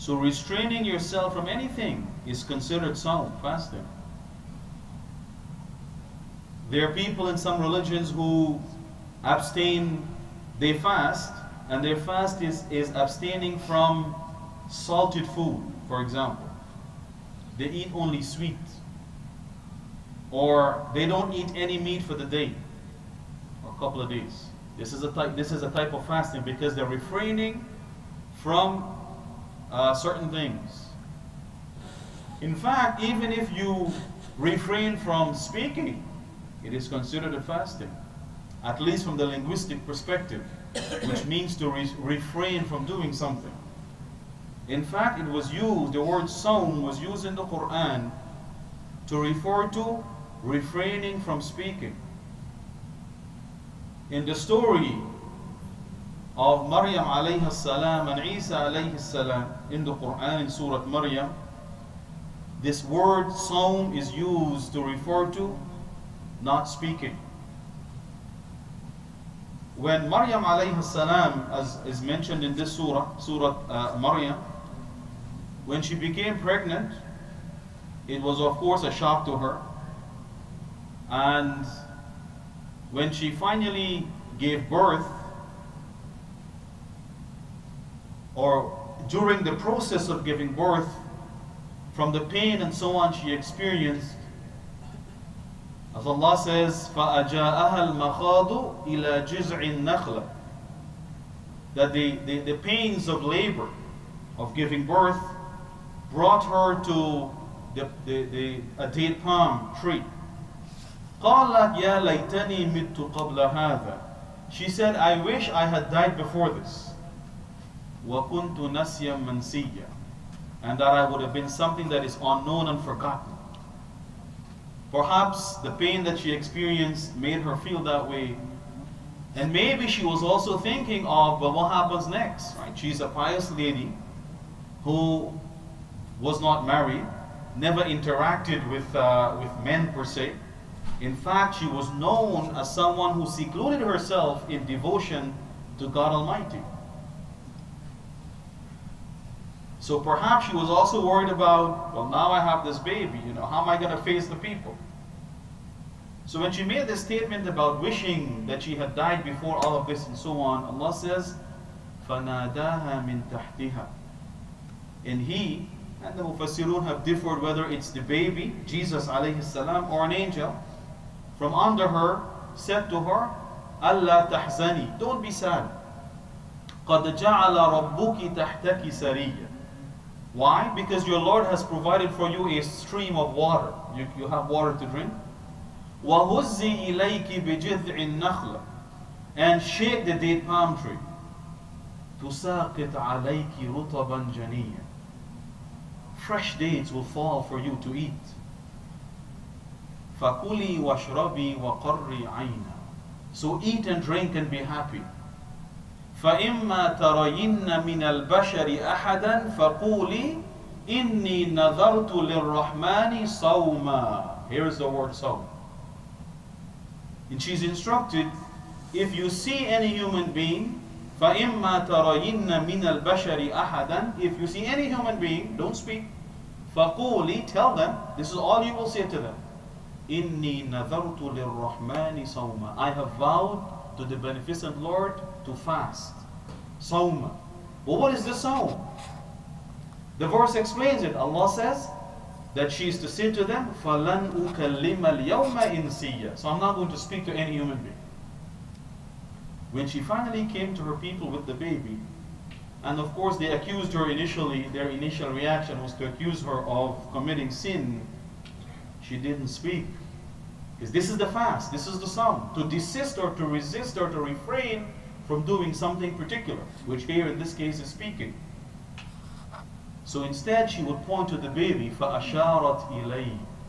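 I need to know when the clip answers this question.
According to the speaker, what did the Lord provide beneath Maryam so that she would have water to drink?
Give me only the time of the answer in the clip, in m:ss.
3:02.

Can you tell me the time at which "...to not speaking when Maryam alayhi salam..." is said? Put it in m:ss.
1:05.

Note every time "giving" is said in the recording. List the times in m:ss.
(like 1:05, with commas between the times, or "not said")
1:30, 1:44.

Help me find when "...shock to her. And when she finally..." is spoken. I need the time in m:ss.
1:18.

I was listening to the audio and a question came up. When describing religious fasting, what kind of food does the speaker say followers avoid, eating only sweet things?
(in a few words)
Salted food.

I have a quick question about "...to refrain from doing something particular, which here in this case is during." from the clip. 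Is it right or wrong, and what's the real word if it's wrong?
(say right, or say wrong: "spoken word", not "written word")
wrong: "speaking", not "during".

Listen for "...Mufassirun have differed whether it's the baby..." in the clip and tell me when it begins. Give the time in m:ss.
2:46.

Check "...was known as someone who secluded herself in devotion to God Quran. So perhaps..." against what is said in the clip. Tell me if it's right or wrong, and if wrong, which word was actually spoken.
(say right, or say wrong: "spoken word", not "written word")
wrong: "Almighty", not "Quran".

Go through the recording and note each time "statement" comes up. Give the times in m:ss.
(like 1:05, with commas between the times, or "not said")
2:37.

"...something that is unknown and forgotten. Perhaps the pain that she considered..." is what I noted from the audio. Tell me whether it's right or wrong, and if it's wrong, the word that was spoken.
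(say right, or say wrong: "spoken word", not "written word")
wrong: "experienced", not "considered".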